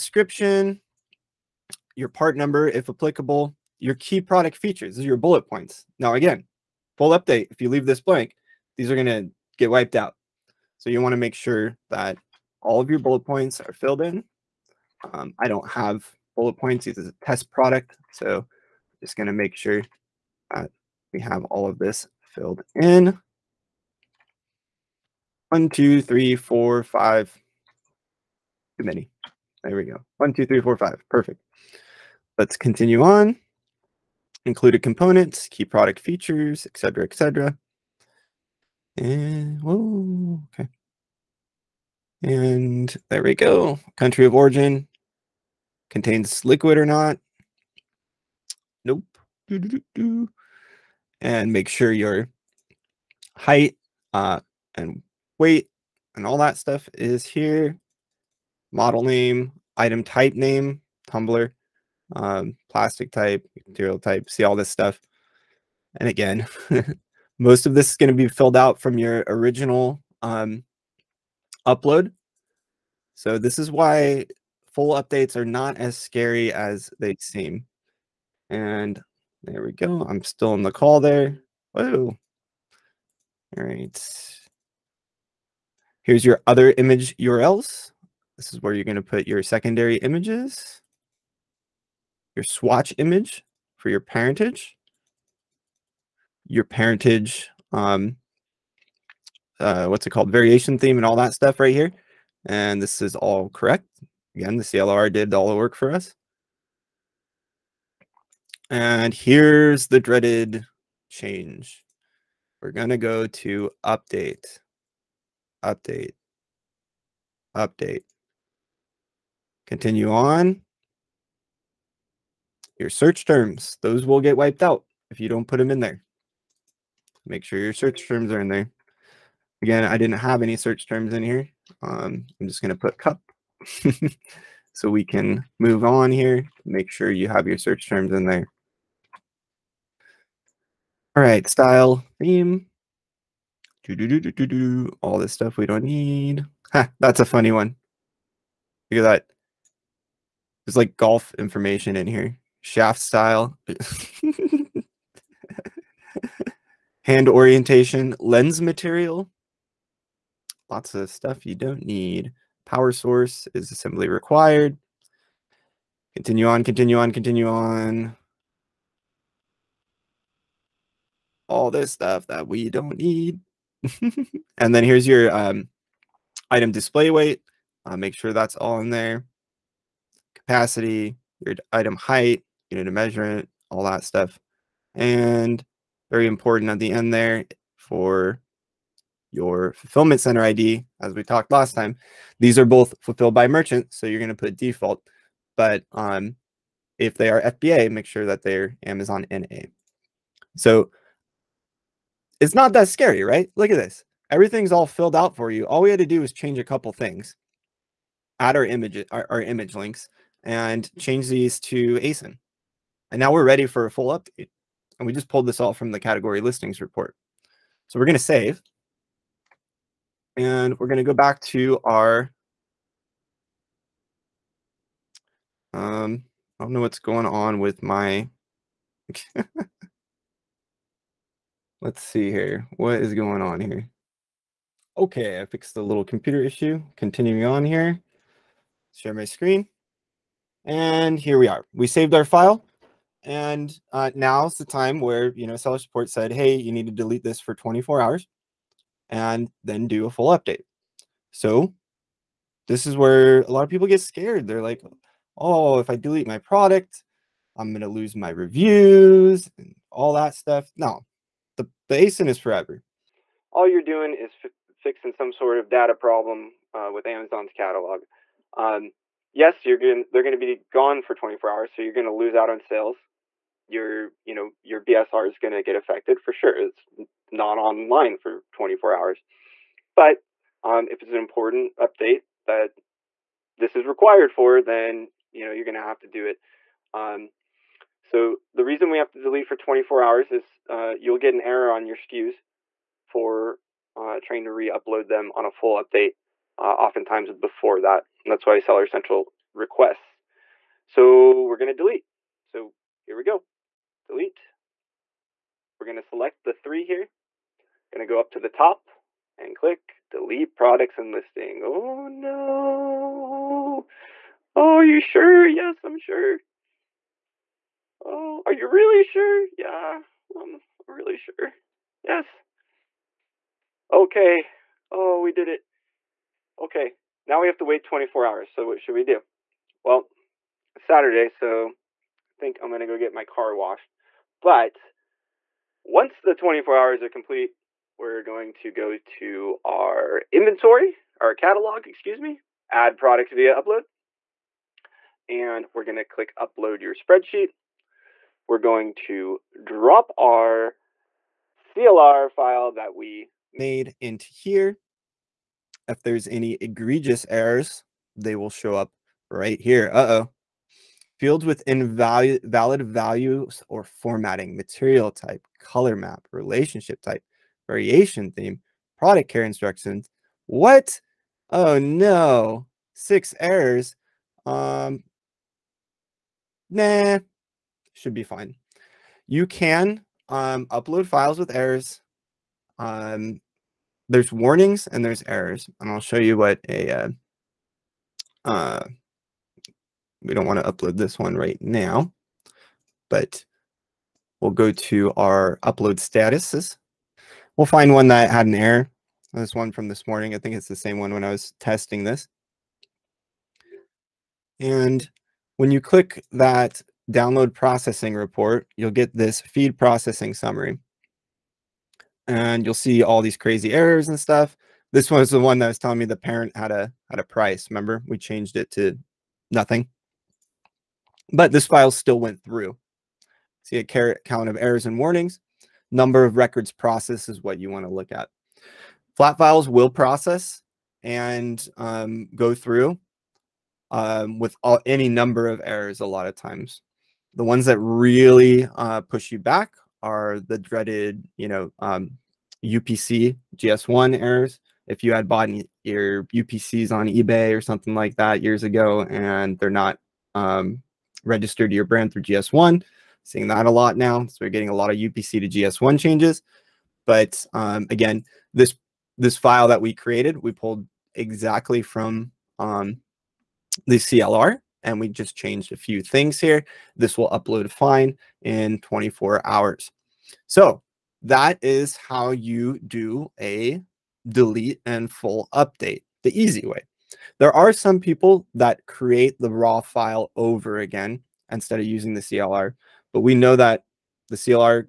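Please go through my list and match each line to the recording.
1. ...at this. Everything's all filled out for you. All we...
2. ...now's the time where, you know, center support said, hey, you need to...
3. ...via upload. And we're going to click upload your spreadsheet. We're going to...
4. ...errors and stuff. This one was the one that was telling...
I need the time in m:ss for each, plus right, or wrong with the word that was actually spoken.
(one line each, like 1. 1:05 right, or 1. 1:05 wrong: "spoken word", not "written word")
1. 3:23 right
2. 4:04 wrong: "seller", not "center"
3. 5:43 right
4. 6:53 right.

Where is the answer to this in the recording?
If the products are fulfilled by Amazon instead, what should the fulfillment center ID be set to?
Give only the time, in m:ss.
3:18.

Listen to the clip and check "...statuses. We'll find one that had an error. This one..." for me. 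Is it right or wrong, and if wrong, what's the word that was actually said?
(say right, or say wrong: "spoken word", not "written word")
right.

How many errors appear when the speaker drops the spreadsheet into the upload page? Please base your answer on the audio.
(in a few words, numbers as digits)
6.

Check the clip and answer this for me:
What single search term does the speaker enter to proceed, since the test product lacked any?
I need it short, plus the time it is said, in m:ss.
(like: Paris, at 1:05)
cup, at 2:12.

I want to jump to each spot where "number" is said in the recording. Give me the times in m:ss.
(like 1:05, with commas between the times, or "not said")
0:02, 7:05, 7:15.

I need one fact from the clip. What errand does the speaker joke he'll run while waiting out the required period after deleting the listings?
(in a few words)
get my car washed.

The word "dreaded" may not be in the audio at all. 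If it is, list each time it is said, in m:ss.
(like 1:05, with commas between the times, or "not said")
1:49, 7:20.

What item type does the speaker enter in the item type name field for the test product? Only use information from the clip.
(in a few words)
Tumbler.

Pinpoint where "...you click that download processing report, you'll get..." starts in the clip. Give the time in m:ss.
6:45.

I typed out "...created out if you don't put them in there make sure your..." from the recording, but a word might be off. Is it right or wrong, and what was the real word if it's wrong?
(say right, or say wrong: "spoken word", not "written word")
wrong: "wiped", not "created".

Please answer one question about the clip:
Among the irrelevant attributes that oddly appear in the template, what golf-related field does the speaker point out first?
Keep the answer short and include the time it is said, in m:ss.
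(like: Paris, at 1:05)
Shaft style, at 2:32.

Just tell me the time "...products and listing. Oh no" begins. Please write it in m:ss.
5:10.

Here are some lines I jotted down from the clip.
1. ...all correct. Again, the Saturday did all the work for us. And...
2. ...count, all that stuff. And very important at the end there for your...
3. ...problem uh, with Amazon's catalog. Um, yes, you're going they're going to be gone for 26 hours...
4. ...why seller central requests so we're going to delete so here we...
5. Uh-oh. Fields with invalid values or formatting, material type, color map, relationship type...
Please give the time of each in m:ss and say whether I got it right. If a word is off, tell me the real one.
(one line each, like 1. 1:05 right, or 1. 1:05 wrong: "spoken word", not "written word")
1. 1:43 wrong: "CLR", not "Saturday"
2. 3:02 wrong: "measurement", not "count"
3. 4:25 wrong: "24", not "26"
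4. 4:58 right
5. 5:59 right.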